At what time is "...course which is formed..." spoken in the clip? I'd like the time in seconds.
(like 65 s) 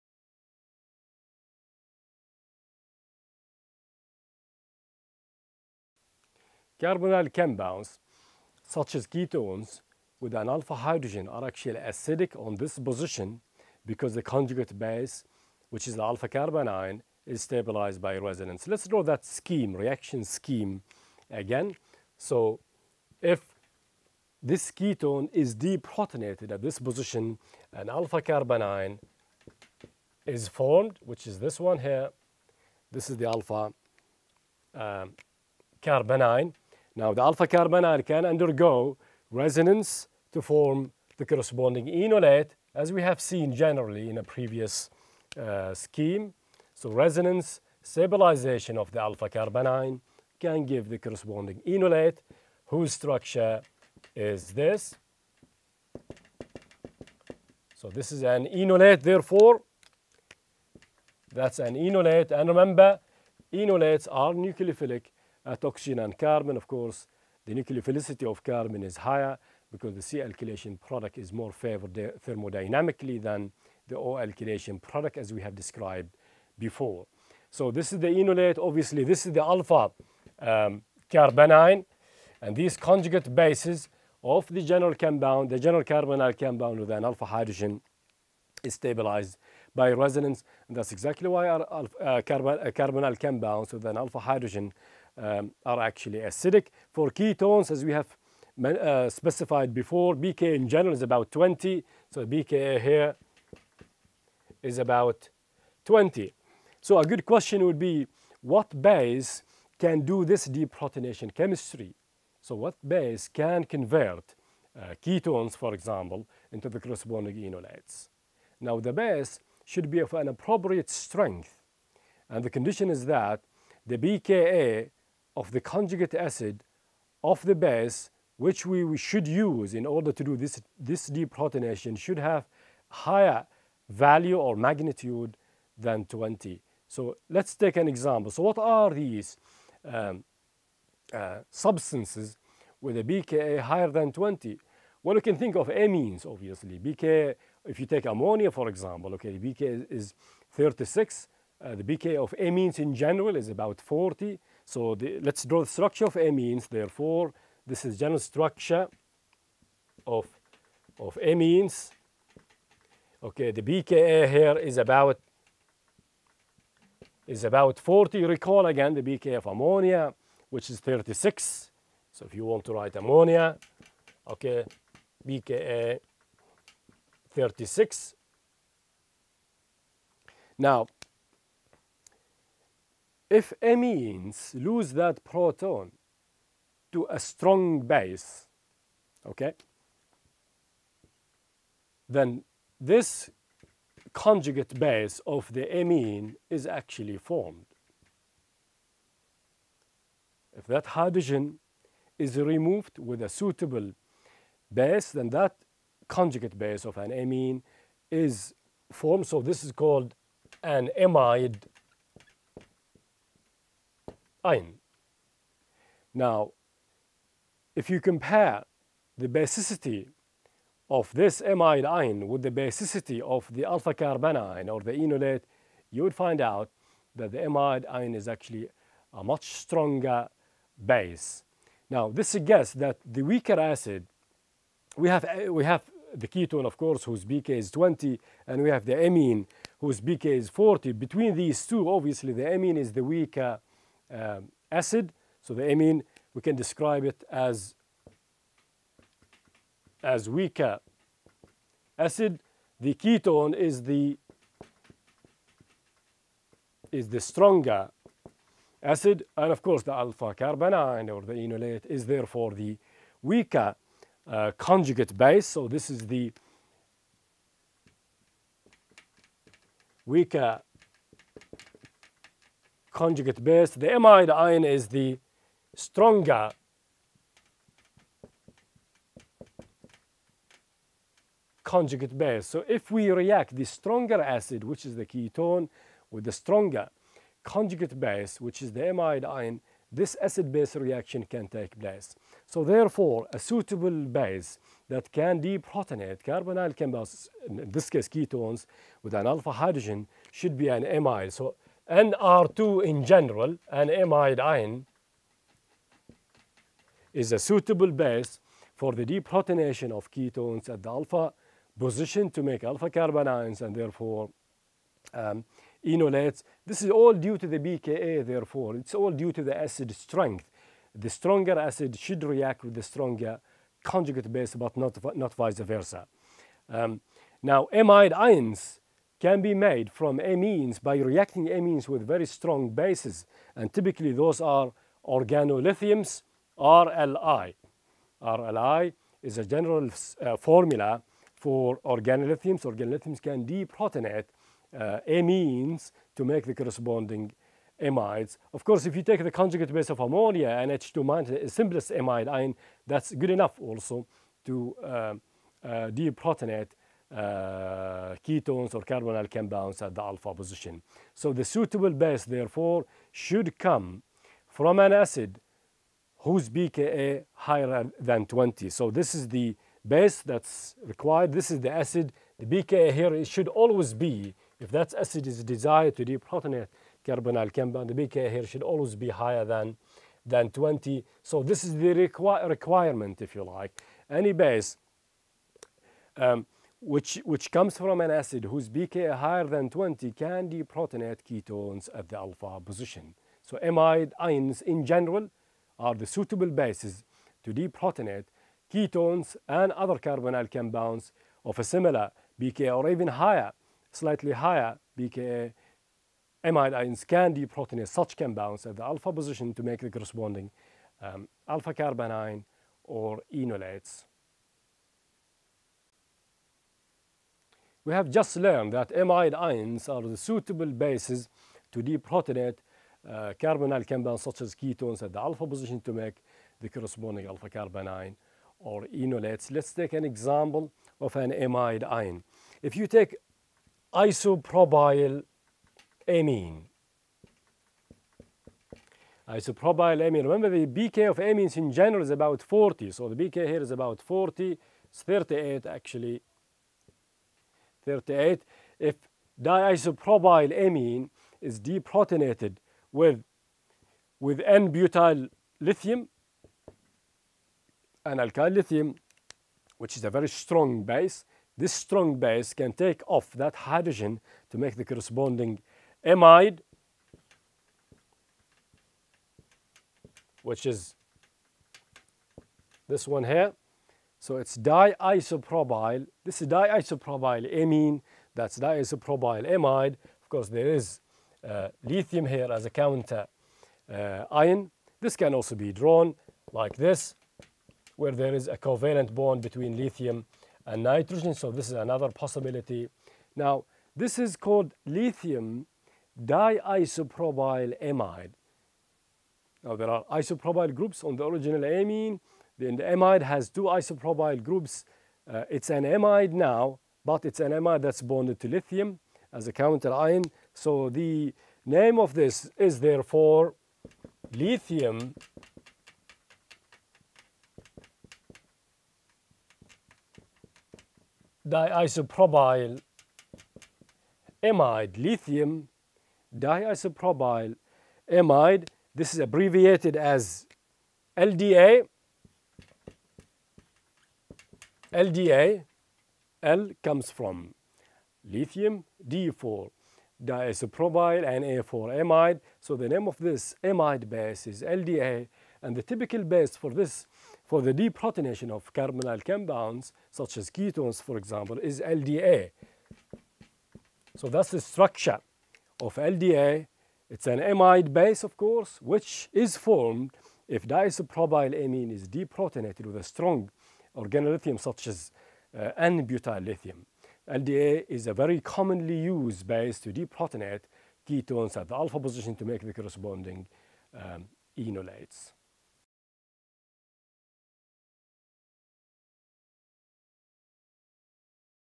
558 s.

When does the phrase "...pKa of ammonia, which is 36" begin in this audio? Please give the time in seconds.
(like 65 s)
169 s.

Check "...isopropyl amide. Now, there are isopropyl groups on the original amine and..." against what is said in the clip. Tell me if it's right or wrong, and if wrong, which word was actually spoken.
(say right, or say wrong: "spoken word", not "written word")
wrong: "diisopropyl", not "isopropyl".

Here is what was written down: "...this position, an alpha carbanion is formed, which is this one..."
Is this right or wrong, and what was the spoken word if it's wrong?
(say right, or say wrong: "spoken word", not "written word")
right.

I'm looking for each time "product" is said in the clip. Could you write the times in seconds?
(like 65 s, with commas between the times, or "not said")
70 s, 74 s.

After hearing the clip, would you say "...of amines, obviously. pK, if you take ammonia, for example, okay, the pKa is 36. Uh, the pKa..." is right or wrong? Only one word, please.
right.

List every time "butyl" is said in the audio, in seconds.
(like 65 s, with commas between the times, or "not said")
454 s, 565 s.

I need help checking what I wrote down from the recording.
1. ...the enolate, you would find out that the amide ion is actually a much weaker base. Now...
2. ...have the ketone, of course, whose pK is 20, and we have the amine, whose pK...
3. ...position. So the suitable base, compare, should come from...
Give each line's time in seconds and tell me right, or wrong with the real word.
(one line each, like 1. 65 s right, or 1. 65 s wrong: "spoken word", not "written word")
1. 224 s wrong: "stronger", not "weaker"
2. 235 s right
3. 360 s wrong: "therefore", not "compare".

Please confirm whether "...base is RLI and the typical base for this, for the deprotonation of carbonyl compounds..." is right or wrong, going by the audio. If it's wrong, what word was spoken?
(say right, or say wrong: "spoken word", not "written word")
wrong: "LDA", not "RLI".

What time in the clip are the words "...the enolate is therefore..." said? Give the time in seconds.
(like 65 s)
261 s.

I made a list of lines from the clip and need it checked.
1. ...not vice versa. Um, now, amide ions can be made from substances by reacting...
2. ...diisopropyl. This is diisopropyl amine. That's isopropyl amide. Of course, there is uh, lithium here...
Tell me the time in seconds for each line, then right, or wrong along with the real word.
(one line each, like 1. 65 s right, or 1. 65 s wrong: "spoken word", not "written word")
1. 325 s wrong: "amines", not "substances"
2. 474 s wrong: "diisopropyl", not "isopropyl".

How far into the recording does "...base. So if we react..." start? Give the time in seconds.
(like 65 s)
282 s.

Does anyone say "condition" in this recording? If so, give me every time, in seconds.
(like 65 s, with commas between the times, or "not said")
122 s.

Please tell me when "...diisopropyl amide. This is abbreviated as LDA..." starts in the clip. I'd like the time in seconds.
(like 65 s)
526 s.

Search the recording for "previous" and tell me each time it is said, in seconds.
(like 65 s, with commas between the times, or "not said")
44 s.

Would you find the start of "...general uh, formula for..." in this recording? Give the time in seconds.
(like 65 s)
339 s.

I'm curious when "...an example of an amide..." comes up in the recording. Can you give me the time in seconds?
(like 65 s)
429 s.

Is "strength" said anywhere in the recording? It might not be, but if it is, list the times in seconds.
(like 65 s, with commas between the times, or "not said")
120 s, 319 s.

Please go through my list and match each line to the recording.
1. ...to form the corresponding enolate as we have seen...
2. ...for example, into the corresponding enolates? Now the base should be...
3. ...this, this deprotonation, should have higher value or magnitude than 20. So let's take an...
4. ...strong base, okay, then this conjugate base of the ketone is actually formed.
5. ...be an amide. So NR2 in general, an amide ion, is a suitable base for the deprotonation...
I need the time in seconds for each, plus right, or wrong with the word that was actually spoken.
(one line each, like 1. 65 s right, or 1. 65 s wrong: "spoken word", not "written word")
1. 40 s right
2. 115 s right
3. 130 s right
4. 187 s wrong: "amine", not "ketone"
5. 300 s right.